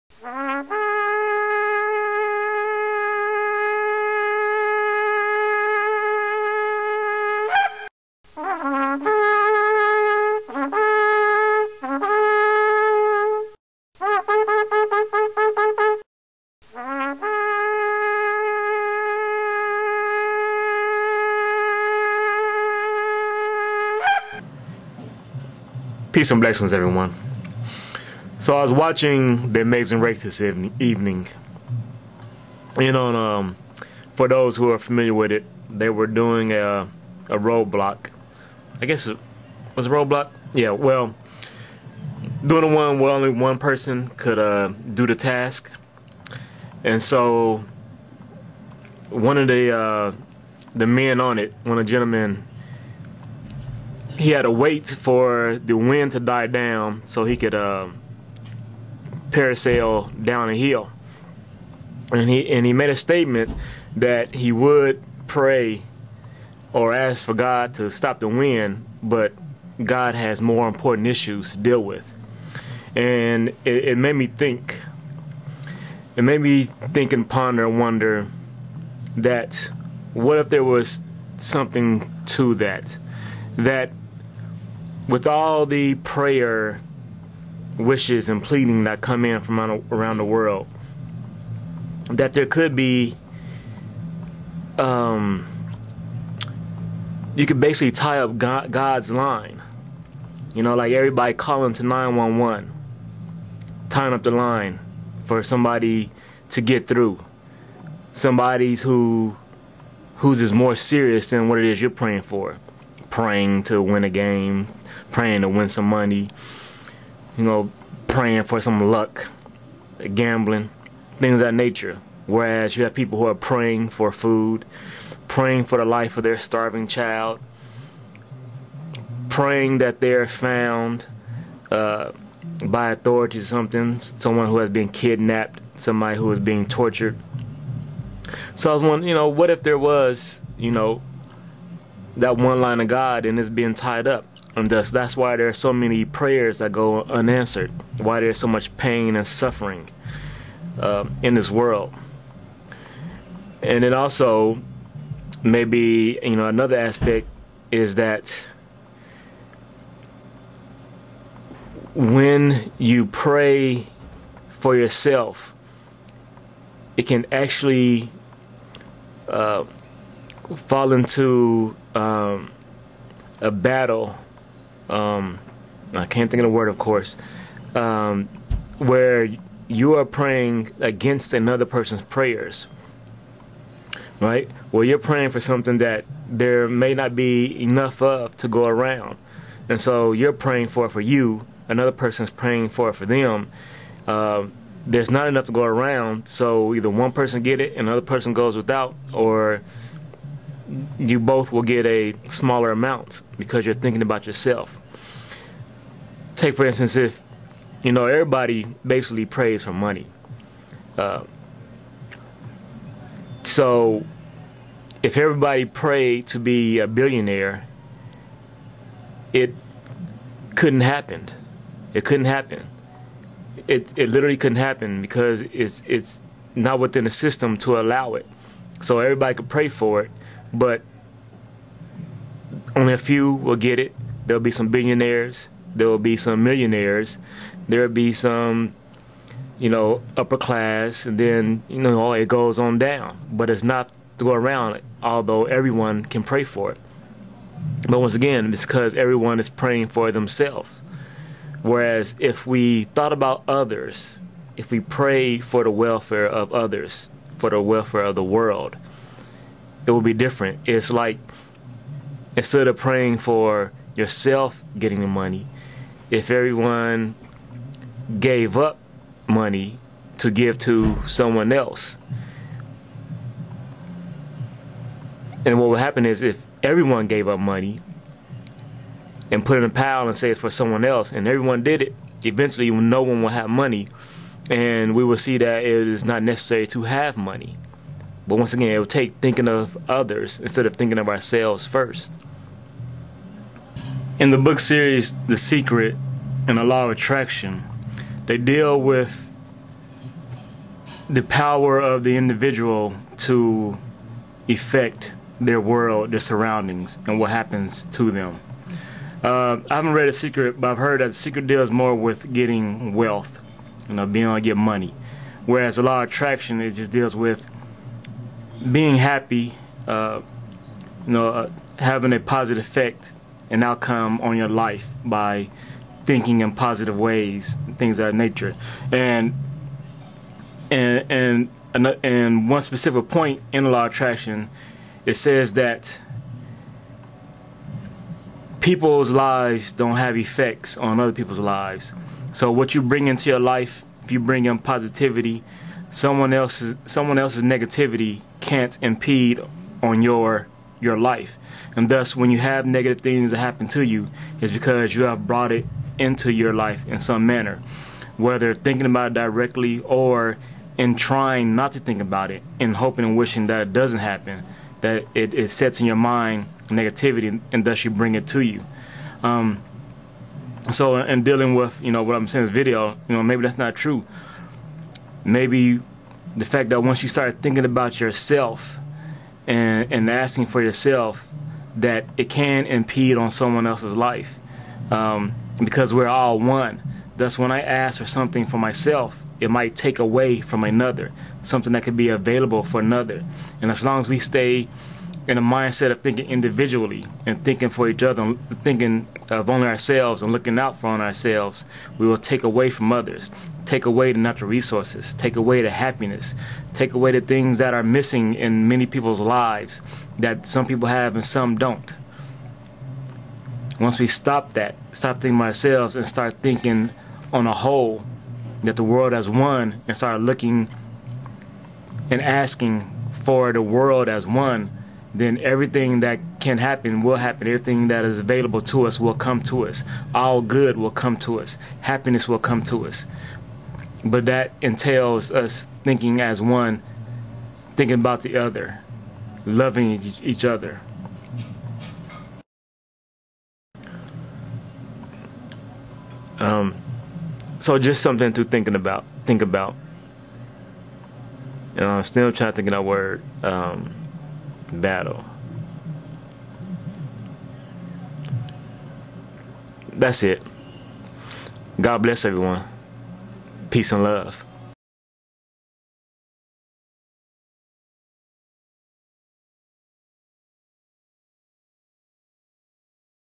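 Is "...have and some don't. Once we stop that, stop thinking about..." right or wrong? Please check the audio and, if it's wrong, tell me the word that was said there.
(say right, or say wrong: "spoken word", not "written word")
right.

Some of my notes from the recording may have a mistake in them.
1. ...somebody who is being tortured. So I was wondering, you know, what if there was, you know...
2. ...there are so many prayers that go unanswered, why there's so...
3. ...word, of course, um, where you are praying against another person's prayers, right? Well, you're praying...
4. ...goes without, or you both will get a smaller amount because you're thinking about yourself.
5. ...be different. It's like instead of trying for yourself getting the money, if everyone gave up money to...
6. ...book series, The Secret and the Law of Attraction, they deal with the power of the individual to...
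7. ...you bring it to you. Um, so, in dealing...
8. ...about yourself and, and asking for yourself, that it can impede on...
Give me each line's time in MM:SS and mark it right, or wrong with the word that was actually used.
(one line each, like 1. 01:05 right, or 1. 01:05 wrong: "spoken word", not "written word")
1. 02:15 right
2. 02:25 right
3. 02:56 right
4. 03:18 right
5. 04:20 wrong: "praying", not "trying"
6. 04:54 right
7. 06:07 right
8. 06:17 right.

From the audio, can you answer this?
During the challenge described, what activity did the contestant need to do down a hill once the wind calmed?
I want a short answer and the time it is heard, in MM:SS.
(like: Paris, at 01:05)
parasail, at 00:59.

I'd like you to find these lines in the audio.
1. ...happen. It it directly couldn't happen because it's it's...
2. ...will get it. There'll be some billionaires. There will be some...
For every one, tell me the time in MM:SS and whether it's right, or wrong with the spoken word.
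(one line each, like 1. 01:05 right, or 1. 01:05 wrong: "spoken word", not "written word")
1. 03:42 wrong: "literally", not "directly"
2. 03:53 right.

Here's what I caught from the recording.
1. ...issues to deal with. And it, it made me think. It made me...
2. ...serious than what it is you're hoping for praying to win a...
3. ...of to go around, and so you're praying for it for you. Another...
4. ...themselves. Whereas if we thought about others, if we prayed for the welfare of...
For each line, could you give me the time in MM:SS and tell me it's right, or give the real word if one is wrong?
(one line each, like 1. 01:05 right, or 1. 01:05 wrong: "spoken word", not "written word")
1. 01:11 right
2. 01:50 wrong: "praying", not "hoping"
3. 03:08 right
4. 04:10 right.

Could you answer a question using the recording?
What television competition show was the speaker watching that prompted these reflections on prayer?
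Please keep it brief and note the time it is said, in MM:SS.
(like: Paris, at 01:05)
The Amazing Race, at 00:29.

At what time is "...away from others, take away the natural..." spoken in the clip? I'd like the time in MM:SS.
06:42.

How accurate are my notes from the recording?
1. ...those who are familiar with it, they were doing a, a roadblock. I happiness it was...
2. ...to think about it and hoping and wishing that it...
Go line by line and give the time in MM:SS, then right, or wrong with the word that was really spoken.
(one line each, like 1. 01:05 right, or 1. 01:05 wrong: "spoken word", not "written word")
1. 00:34 wrong: "guess", not "happiness"
2. 06:01 right.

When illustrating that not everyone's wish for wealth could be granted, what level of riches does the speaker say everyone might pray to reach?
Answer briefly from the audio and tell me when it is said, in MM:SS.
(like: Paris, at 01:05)
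billionaire, at 03:36.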